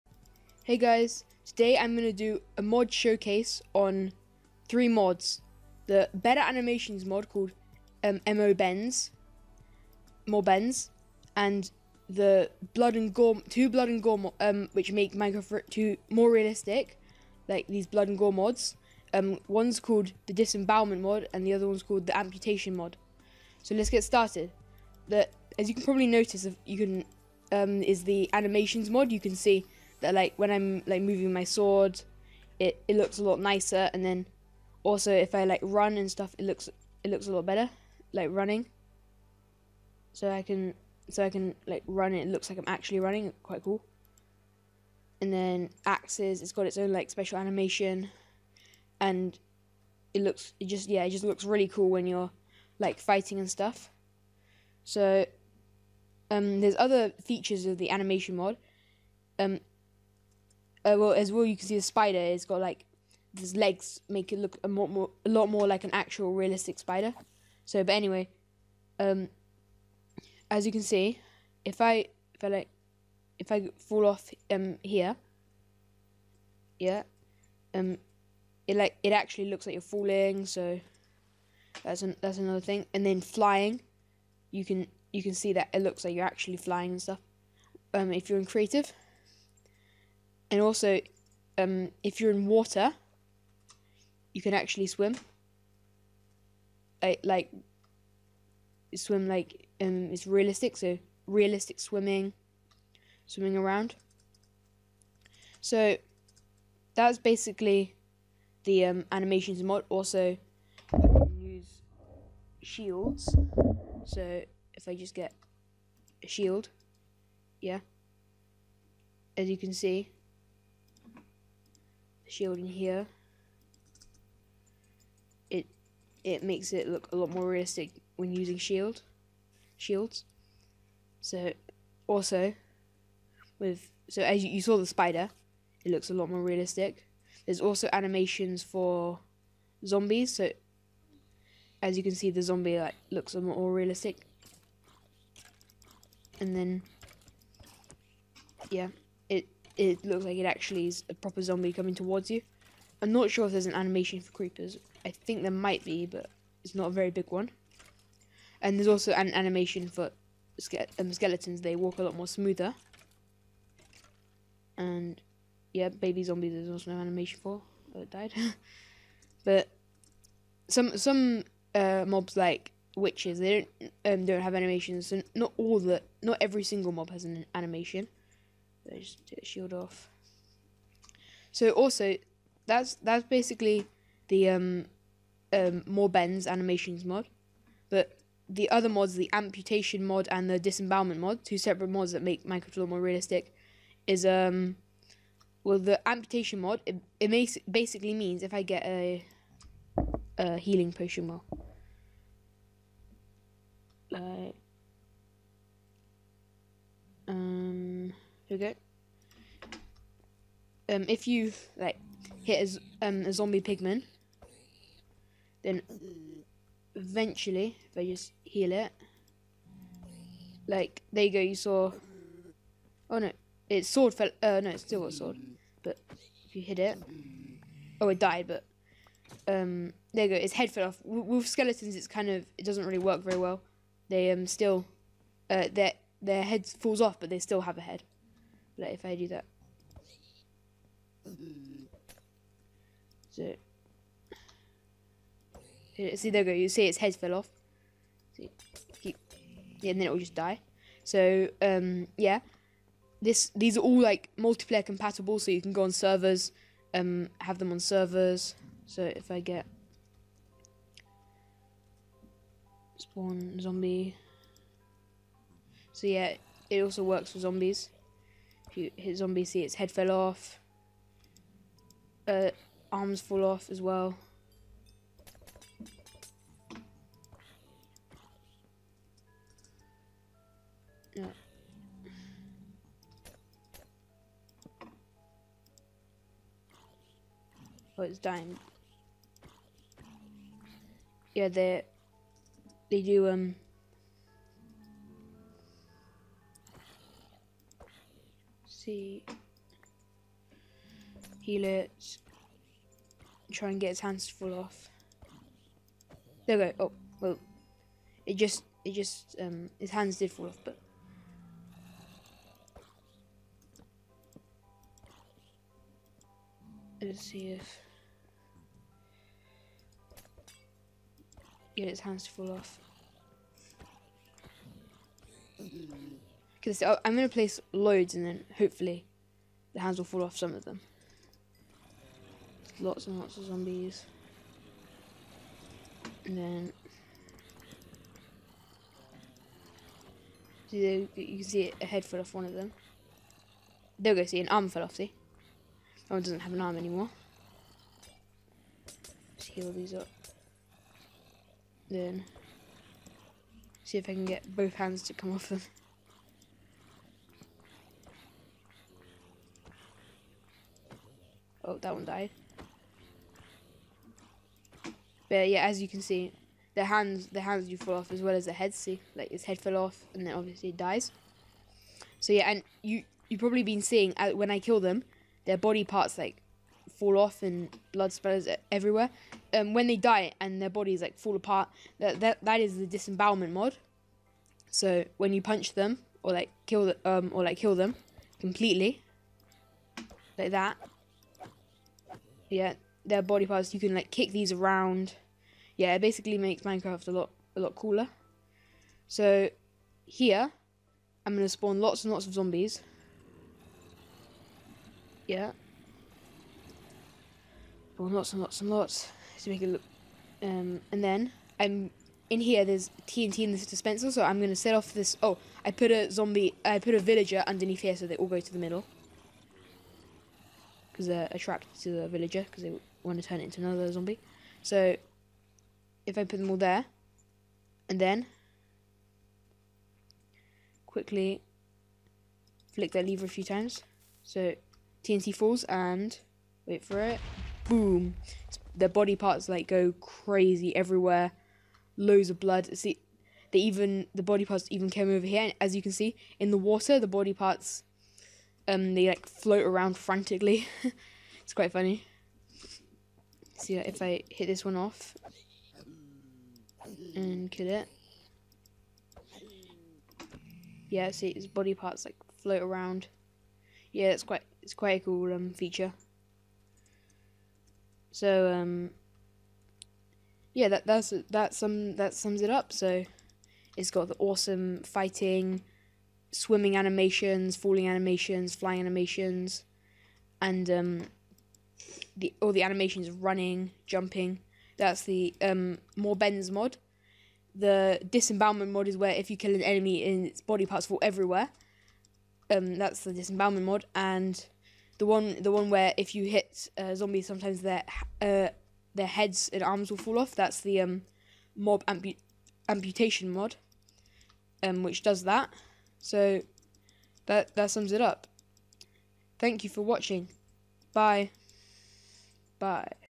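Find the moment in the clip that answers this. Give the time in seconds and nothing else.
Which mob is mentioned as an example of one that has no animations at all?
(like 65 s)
172 s.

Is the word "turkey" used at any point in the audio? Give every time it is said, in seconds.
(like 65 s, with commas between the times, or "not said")
not said.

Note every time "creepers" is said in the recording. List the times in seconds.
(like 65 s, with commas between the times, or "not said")
154 s.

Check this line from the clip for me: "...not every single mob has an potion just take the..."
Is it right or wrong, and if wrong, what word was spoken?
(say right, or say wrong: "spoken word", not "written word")
wrong: "animation", not "potion".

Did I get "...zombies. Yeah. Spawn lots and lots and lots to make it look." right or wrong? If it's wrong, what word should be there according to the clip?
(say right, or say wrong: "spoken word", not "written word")
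right.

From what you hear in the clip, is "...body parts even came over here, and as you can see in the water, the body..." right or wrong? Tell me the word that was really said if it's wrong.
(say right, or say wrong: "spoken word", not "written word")
right.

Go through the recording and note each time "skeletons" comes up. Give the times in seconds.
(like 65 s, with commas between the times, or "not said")
161 s, 231 s.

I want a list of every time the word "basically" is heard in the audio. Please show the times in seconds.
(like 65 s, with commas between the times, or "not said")
107 s, 183 s, 197 s, 396 s.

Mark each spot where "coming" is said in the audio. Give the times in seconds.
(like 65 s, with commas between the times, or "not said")
151 s.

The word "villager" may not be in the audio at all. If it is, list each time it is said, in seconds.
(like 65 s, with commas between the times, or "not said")
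416 s, 422 s.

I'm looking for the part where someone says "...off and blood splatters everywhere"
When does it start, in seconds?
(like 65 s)
377 s.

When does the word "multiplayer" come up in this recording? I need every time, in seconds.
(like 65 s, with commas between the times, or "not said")
254 s.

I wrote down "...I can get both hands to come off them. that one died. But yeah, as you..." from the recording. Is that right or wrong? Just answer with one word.
right.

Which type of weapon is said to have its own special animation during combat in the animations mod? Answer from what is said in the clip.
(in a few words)
Axes.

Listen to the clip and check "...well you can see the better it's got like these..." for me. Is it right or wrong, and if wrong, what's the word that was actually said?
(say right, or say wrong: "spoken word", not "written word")
wrong: "spider", not "better".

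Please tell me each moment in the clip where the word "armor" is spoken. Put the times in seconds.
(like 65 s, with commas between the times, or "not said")
not said.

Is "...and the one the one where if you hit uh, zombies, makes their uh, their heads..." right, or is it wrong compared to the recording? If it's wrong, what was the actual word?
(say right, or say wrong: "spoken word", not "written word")
wrong: "sometimes", not "makes".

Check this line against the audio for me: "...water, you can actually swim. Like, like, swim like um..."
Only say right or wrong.
right.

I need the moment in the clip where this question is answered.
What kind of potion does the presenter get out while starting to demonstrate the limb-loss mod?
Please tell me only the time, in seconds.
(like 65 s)
200 s.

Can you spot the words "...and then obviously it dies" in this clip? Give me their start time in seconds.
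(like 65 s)
370 s.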